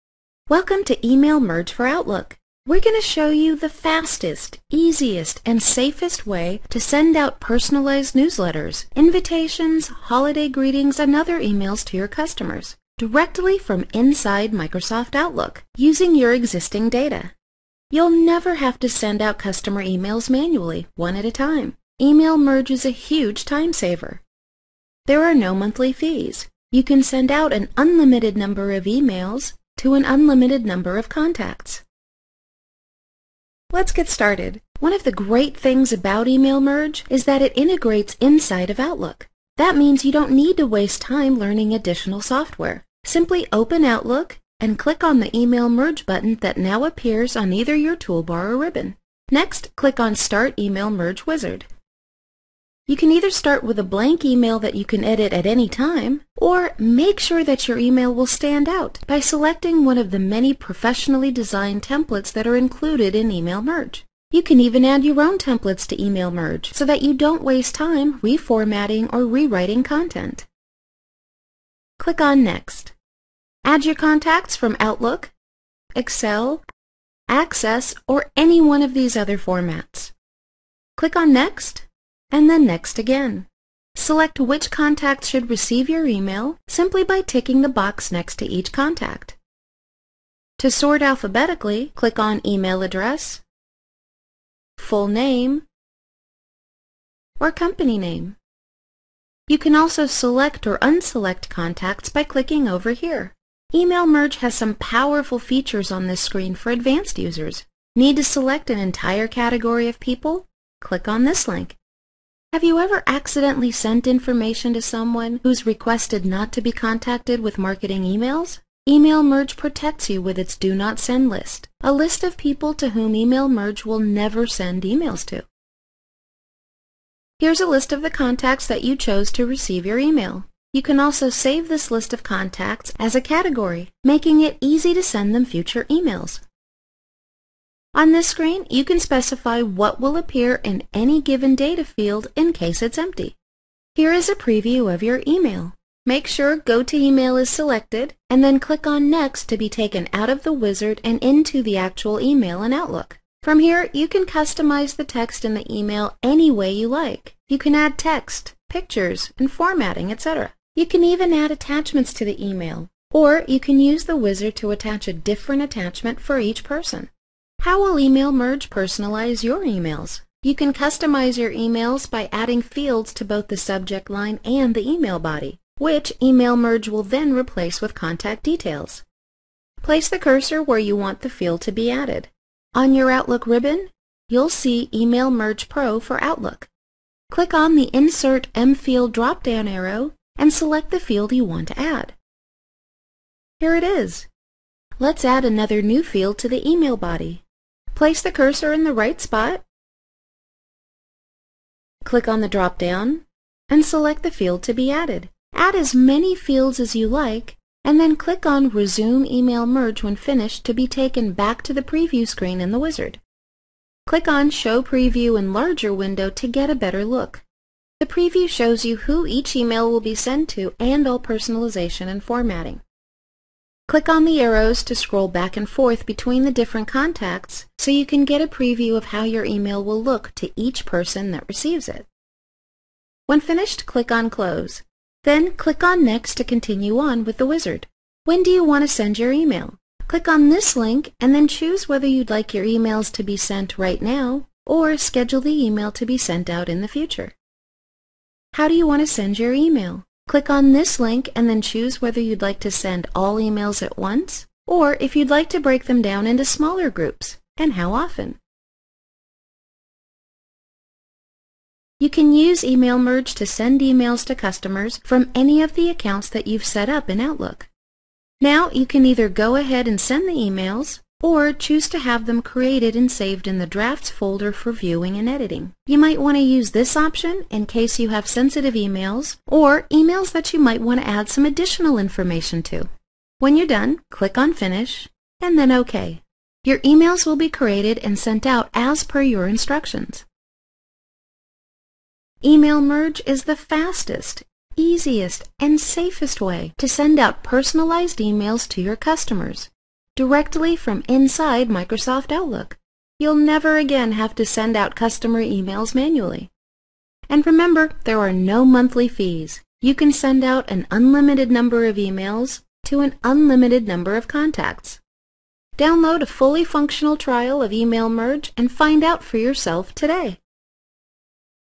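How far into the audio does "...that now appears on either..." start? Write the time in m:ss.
0:46.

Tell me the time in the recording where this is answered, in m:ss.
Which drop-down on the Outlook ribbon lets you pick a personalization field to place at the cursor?
3:07.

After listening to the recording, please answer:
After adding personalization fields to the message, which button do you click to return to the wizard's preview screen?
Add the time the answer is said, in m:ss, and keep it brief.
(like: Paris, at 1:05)
Resume Email Merge, at 3:28.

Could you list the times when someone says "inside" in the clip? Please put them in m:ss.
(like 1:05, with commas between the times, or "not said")
0:13, 0:38, 5:01.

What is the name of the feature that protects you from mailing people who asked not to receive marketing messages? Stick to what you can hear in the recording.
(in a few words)
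Do Not Send list.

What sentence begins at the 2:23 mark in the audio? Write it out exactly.
Here is a preview of your email.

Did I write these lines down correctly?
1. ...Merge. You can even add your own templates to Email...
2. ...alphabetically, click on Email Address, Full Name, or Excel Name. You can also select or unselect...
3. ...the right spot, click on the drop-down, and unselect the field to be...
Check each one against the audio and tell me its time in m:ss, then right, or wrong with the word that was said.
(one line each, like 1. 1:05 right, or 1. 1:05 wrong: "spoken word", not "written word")
1. 1:03 right
2. 1:31 wrong: "Company", not "Excel"
3. 3:18 wrong: "select", not "unselect".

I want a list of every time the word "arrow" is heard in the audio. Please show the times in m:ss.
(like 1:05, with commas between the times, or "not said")
3:09, 3:44.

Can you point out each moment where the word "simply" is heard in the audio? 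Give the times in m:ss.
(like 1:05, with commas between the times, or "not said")
0:43, 1:26.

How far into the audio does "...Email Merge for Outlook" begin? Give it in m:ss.
0:01.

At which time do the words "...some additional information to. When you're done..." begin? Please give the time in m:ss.
4:41.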